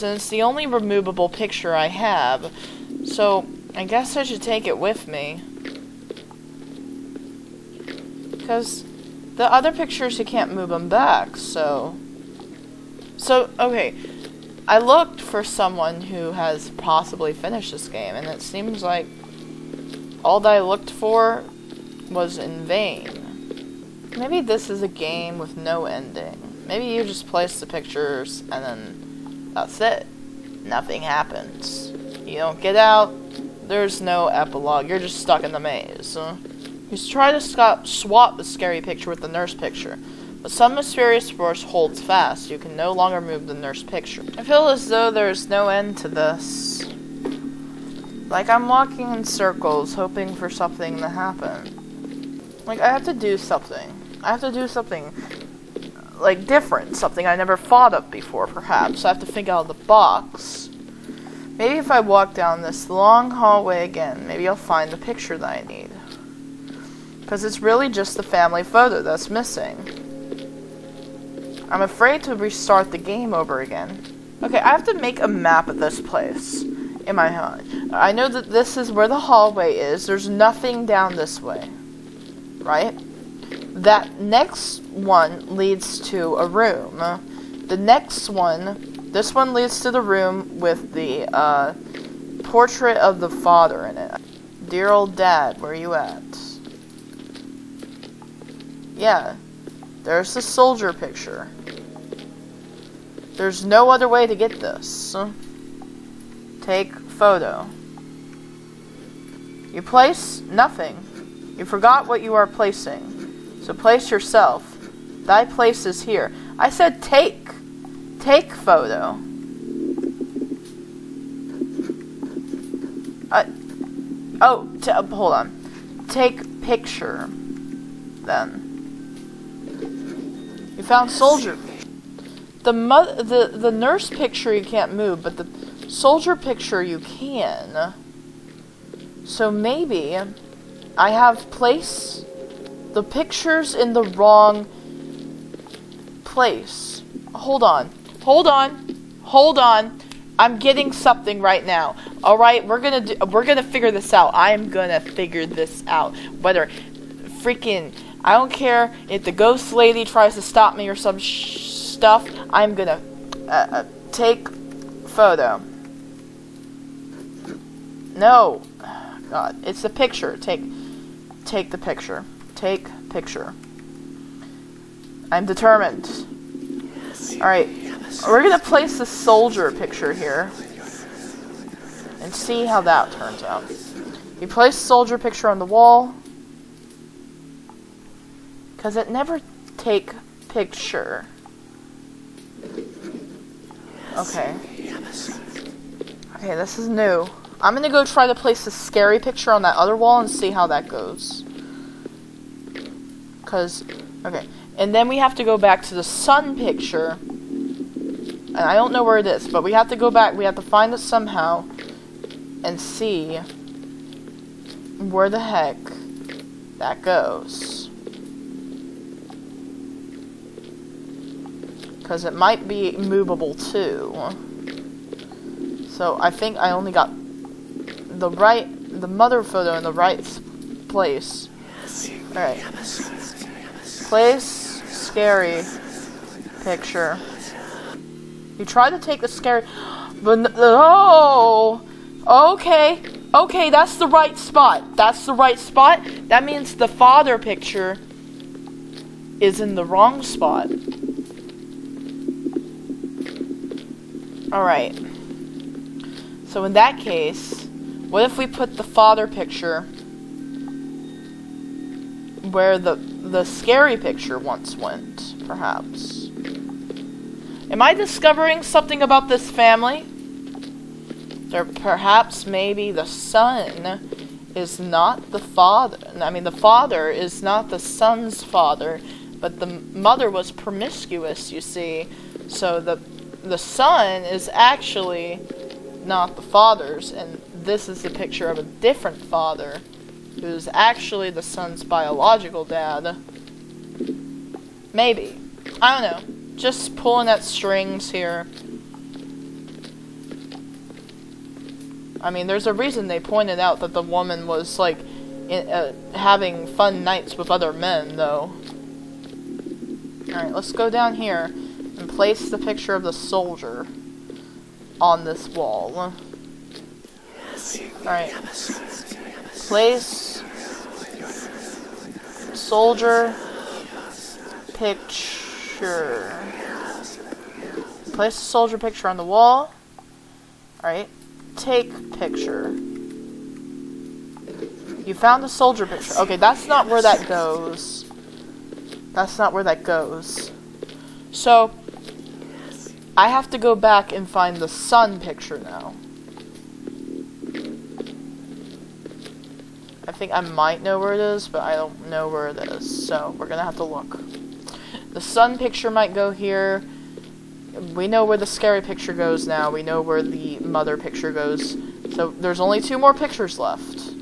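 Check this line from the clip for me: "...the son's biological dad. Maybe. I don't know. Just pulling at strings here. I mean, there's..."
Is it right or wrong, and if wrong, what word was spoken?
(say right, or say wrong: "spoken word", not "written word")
right.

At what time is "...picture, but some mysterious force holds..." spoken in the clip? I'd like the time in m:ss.
0:39.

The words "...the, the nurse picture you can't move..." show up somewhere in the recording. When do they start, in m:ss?
2:12.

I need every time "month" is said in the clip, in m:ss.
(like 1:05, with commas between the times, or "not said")
not said.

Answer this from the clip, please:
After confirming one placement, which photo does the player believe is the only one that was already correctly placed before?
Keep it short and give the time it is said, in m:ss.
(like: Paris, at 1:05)
Mother photo, at 3:49.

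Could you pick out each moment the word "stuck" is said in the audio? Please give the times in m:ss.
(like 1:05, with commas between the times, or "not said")
0:35.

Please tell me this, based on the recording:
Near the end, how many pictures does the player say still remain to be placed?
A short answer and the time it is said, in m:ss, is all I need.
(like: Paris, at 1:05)
2, at 6:02.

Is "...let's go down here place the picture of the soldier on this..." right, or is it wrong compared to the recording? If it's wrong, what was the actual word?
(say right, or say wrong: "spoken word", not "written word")
right.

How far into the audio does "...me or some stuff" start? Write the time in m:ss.
2:40.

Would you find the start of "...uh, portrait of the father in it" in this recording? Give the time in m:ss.
1:31.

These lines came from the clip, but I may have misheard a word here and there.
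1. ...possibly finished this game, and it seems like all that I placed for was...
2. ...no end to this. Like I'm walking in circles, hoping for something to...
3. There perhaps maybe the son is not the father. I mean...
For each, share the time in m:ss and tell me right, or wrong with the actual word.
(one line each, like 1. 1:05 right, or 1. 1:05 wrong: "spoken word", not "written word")
1. 0:16 wrong: "looked", not "placed"
2. 0:45 right
3. 4:30 right.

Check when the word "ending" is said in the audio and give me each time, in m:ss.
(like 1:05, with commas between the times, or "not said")
0:25.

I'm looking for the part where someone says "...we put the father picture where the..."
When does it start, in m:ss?
4:18.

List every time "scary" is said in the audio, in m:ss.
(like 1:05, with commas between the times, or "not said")
0:38, 3:18, 3:54, 3:59, 4:23, 5:58.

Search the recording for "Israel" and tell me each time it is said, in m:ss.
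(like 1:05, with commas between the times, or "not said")
not said.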